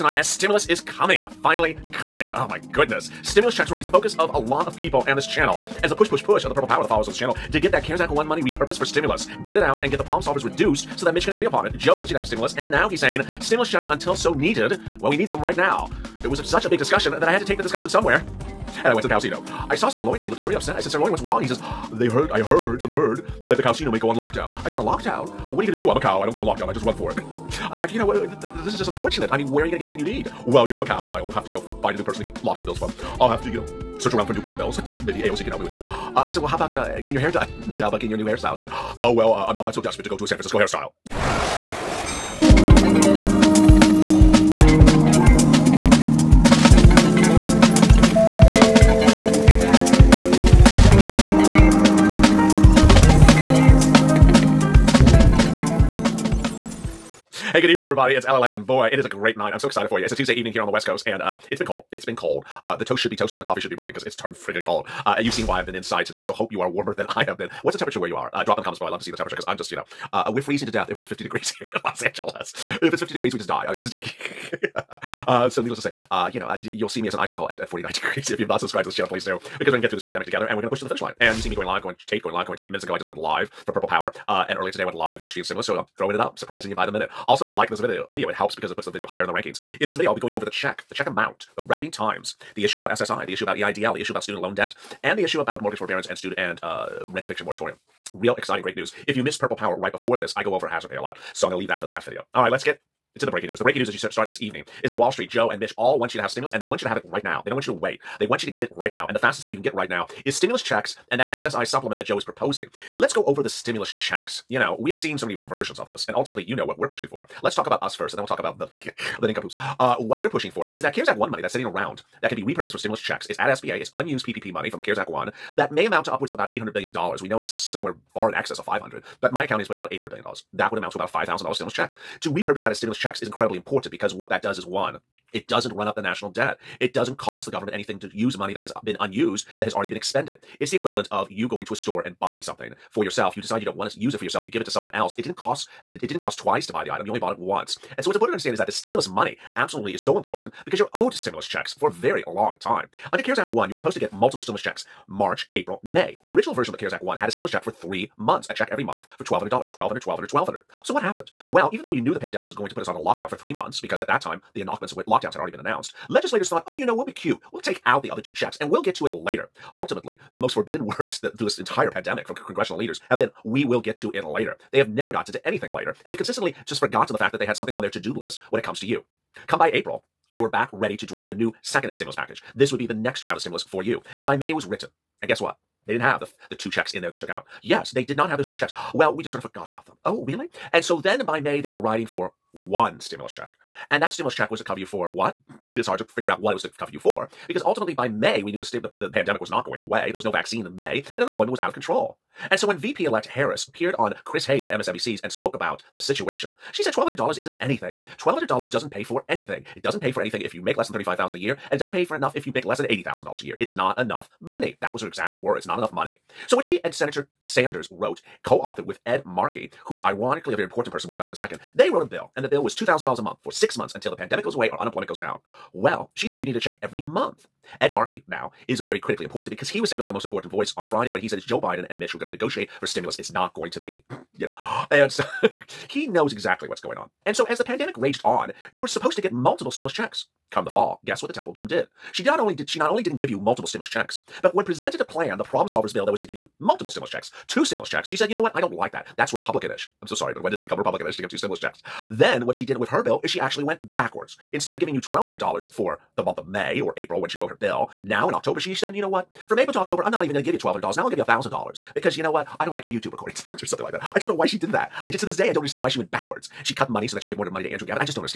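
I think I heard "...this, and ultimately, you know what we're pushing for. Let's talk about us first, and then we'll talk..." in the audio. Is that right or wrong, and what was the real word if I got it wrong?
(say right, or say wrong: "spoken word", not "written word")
right.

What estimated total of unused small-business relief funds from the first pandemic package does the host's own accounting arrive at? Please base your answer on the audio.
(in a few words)
$800 billion.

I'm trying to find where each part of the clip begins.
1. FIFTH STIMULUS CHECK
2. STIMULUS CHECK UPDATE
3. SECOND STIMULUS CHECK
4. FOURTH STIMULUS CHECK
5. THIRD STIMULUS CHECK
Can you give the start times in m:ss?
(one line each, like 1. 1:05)
1. 2:37
2. 0:30
3. 1:02
4. 2:05
5. 1:33.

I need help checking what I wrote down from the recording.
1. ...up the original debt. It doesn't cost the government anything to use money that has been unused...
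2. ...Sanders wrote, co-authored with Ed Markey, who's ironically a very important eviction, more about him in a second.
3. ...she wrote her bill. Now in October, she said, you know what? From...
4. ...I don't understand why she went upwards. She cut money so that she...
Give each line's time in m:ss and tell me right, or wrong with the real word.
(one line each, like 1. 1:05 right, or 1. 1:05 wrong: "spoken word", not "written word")
1. 2:15 wrong: "national", not "original"
2. 3:37 wrong: "person", not "eviction"
3. 4:17 right
4. 4:25 wrong: "backwards", not "upwards".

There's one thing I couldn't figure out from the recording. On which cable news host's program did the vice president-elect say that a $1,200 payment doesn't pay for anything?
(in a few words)
Chris Hayes.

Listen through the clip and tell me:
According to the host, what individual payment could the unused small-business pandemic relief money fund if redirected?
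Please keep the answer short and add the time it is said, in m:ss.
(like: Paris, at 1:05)
$5,000, at 2:11.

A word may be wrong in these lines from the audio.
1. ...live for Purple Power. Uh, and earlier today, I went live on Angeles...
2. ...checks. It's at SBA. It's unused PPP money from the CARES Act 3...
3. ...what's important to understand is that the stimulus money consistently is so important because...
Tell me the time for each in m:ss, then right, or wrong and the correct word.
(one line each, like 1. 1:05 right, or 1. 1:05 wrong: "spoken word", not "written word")
1. 1:23 wrong: "Stream", not "Angeles"
2. 2:02 wrong: "1", not "3"
3. 2:28 wrong: "absolutely", not "consistently".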